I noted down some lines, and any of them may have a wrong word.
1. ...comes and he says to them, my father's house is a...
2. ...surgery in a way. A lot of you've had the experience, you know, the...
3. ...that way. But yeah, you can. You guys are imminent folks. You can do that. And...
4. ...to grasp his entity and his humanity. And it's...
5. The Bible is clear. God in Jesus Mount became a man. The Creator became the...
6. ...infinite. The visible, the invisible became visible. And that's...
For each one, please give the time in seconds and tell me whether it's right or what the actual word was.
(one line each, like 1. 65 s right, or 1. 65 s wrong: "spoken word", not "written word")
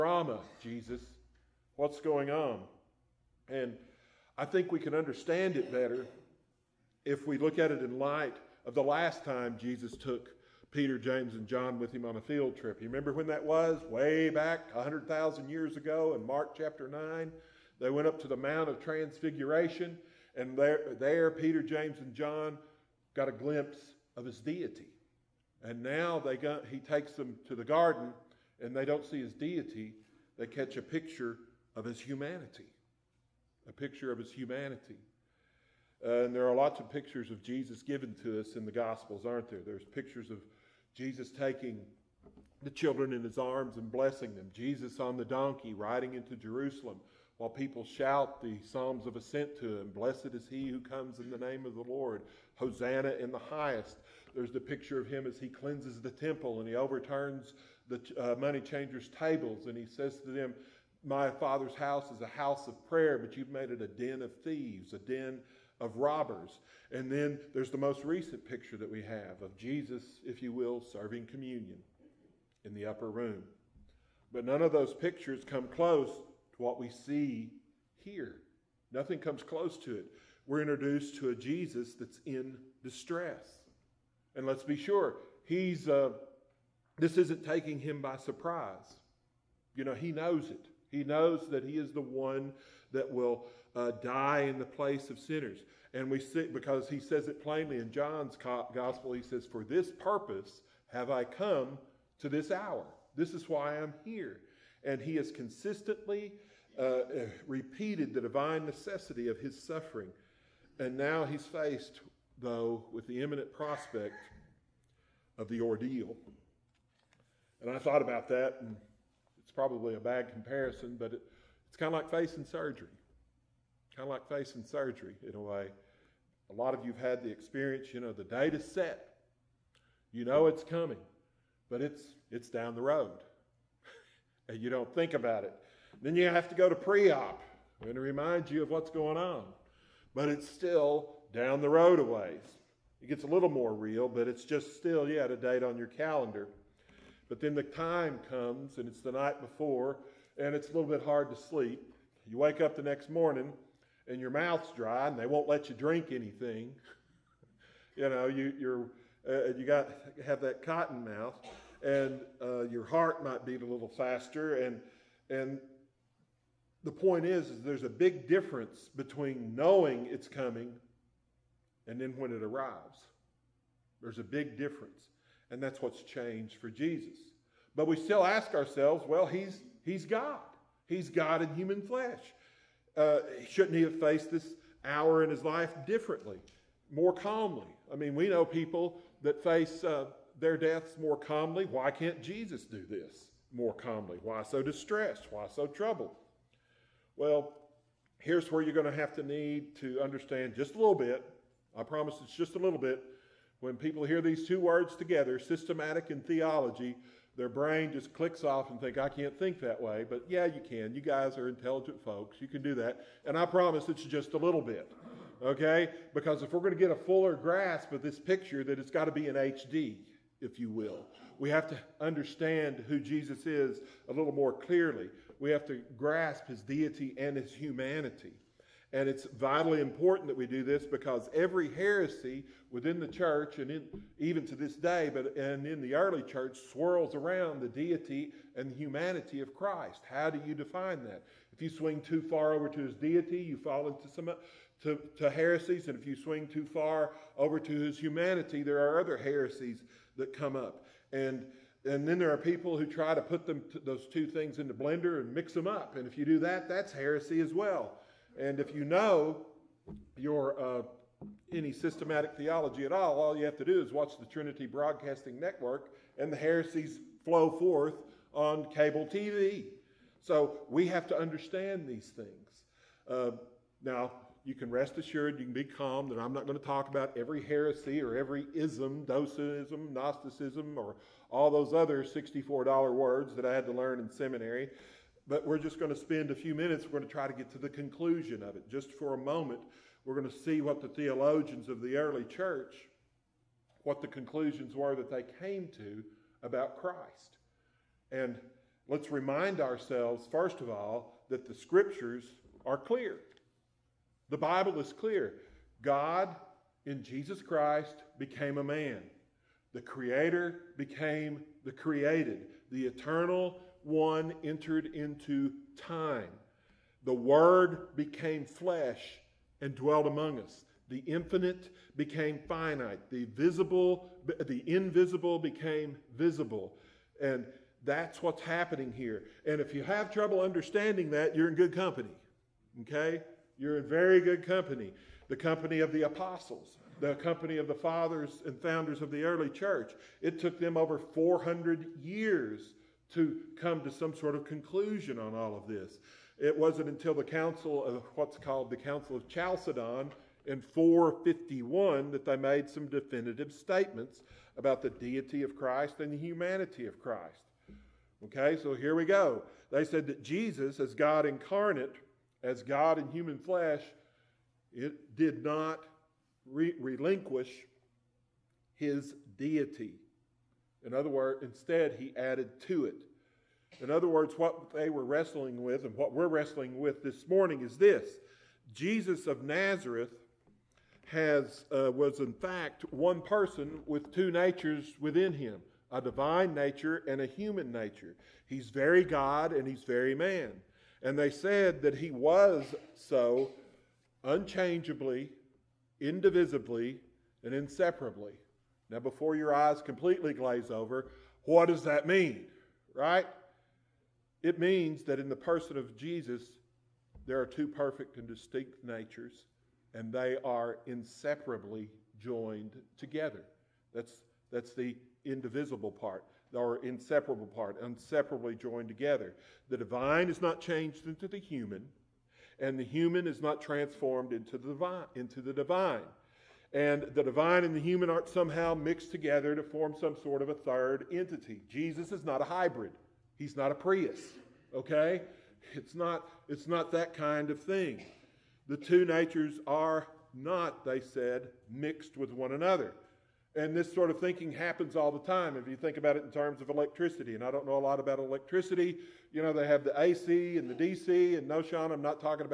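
1. 59 s wrong: "tables", not "comes"
2. 124 s right
3. 209 s wrong: "intelligent", not "imminent"
4. 225 s wrong: "deity", not "entity"
5. 304 s wrong: "Christ", not "Mount"
6. 322 s wrong: "finite", not "infinite".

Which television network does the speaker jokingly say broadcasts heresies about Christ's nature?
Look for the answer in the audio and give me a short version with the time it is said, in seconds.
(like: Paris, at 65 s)
Trinity Broadcasting Network, at 264 s.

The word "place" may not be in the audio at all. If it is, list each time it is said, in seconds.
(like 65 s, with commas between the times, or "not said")
94 s.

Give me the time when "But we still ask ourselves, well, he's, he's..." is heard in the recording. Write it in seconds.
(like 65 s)
177 s.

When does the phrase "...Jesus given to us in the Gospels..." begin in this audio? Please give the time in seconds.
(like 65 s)
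37 s.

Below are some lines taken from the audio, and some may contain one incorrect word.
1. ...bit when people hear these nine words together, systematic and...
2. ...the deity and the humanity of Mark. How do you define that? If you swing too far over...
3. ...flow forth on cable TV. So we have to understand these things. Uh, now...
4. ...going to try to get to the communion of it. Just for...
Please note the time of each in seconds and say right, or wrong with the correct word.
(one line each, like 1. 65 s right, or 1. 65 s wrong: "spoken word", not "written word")
1. 202 s wrong: "two", not "nine"
2. 237 s wrong: "Christ", not "Mark"
3. 267 s right
4. 286 s wrong: "conclusion", not "communion".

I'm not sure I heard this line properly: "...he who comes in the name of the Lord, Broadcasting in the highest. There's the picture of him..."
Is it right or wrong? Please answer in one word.
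wrong.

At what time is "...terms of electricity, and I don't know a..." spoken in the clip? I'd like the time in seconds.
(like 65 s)
446 s.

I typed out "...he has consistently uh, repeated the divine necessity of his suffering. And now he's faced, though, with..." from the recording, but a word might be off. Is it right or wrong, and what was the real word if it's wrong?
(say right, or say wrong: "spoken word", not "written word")
right.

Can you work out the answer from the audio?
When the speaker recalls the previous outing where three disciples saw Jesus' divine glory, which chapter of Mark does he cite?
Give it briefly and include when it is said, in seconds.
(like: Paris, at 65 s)
Mark chapter 9, at 16 s.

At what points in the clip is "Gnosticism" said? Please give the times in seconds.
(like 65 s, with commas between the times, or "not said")
279 s.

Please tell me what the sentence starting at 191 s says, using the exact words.
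Why can't Jesus do this more calmly?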